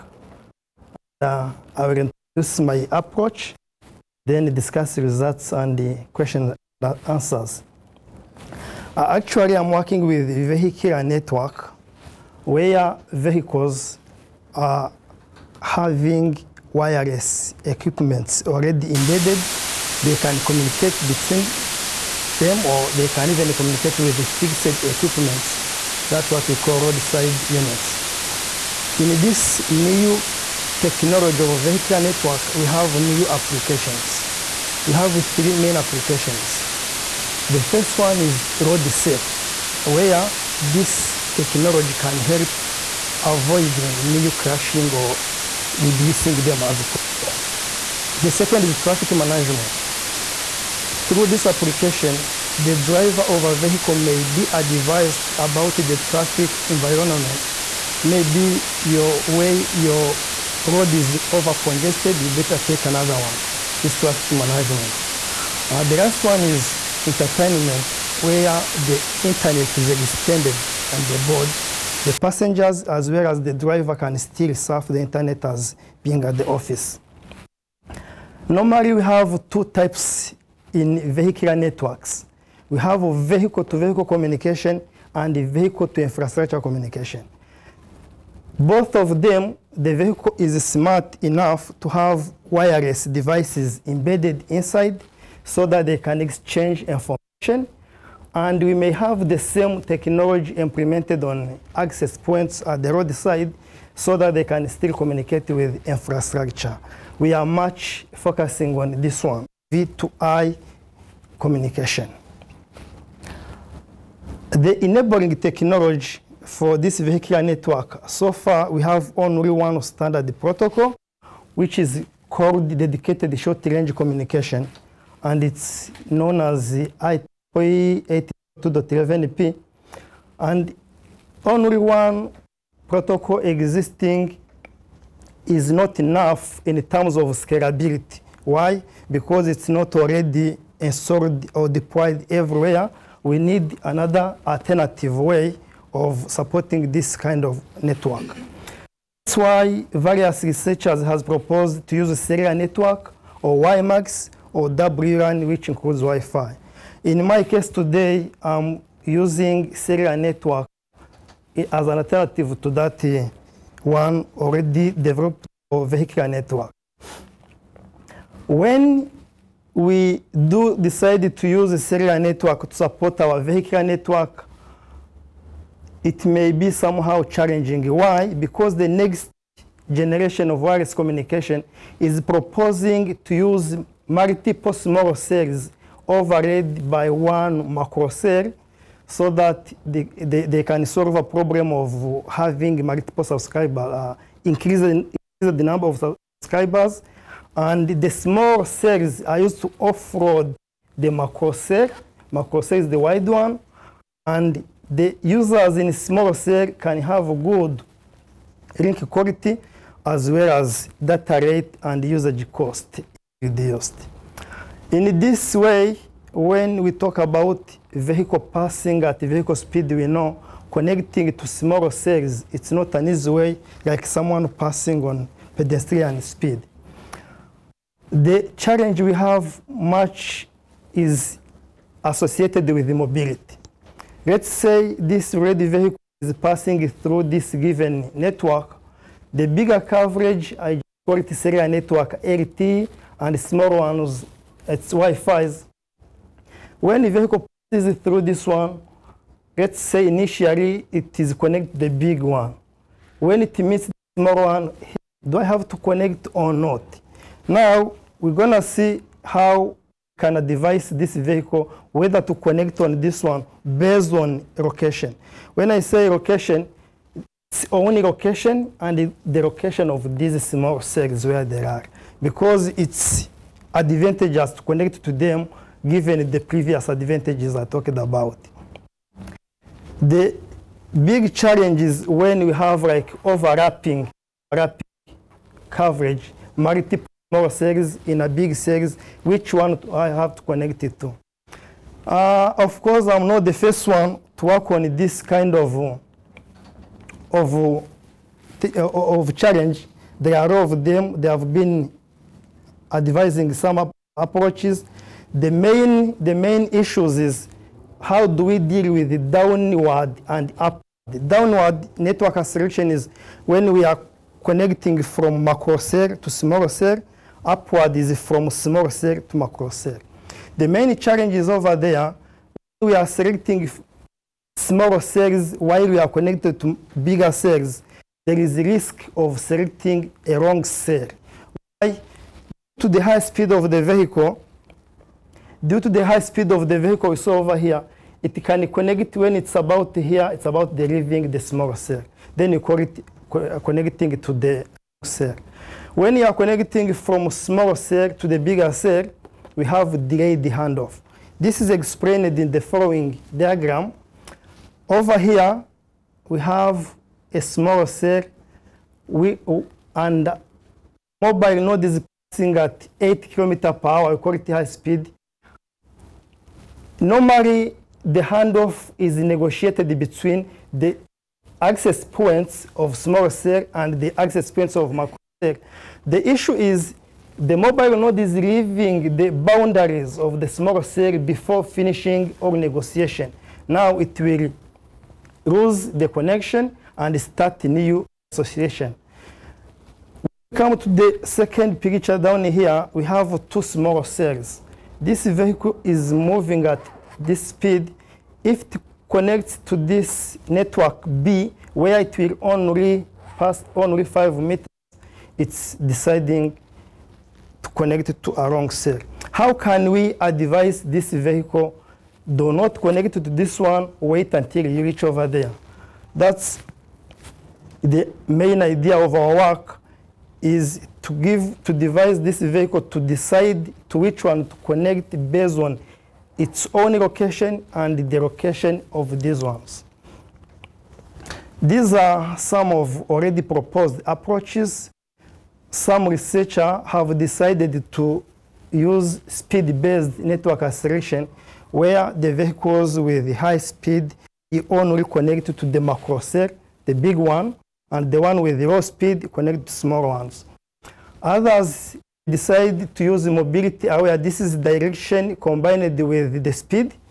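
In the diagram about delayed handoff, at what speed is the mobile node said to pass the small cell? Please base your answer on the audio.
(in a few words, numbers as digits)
8 km per hour.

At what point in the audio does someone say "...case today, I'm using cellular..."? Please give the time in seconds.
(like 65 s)
157 s.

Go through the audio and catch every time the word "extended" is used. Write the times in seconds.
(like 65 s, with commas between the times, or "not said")
69 s.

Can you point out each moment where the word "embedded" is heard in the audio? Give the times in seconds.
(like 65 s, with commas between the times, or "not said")
18 s, 93 s.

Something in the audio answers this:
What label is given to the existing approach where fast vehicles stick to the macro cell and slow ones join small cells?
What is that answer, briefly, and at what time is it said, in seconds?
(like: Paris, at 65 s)
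speed-based network selection, at 439 s.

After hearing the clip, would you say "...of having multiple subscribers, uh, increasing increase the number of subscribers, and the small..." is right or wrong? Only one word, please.
right.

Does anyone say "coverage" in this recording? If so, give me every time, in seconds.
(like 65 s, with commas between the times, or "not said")
239 s, 285 s.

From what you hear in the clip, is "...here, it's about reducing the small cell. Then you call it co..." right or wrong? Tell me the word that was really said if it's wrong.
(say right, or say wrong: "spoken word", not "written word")
wrong: "delivering", not "reducing".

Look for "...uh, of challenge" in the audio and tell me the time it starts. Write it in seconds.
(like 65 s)
298 s.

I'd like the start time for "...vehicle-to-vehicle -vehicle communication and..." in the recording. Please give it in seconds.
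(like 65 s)
83 s.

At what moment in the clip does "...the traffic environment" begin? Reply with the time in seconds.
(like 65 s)
55 s.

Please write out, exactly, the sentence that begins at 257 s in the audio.
Now, we're going to see how can I device this vehicle, whether to connect on this one based on location.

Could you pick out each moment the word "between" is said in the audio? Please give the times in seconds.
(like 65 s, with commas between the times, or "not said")
21 s, 369 s.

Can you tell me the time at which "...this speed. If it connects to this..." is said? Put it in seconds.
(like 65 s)
397 s.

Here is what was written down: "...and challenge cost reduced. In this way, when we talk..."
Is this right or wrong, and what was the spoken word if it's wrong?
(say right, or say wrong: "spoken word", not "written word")
wrong: "usage", not "challenge".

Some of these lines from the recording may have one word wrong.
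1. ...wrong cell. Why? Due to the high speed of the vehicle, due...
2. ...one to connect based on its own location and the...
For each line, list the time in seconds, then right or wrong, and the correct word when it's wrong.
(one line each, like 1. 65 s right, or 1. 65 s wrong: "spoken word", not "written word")
1. 330 s right
2. 424 s right.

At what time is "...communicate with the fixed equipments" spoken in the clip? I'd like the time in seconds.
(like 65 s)
23 s.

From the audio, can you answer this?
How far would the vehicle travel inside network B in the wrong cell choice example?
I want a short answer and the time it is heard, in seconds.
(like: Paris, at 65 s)
5 meters, at 404 s.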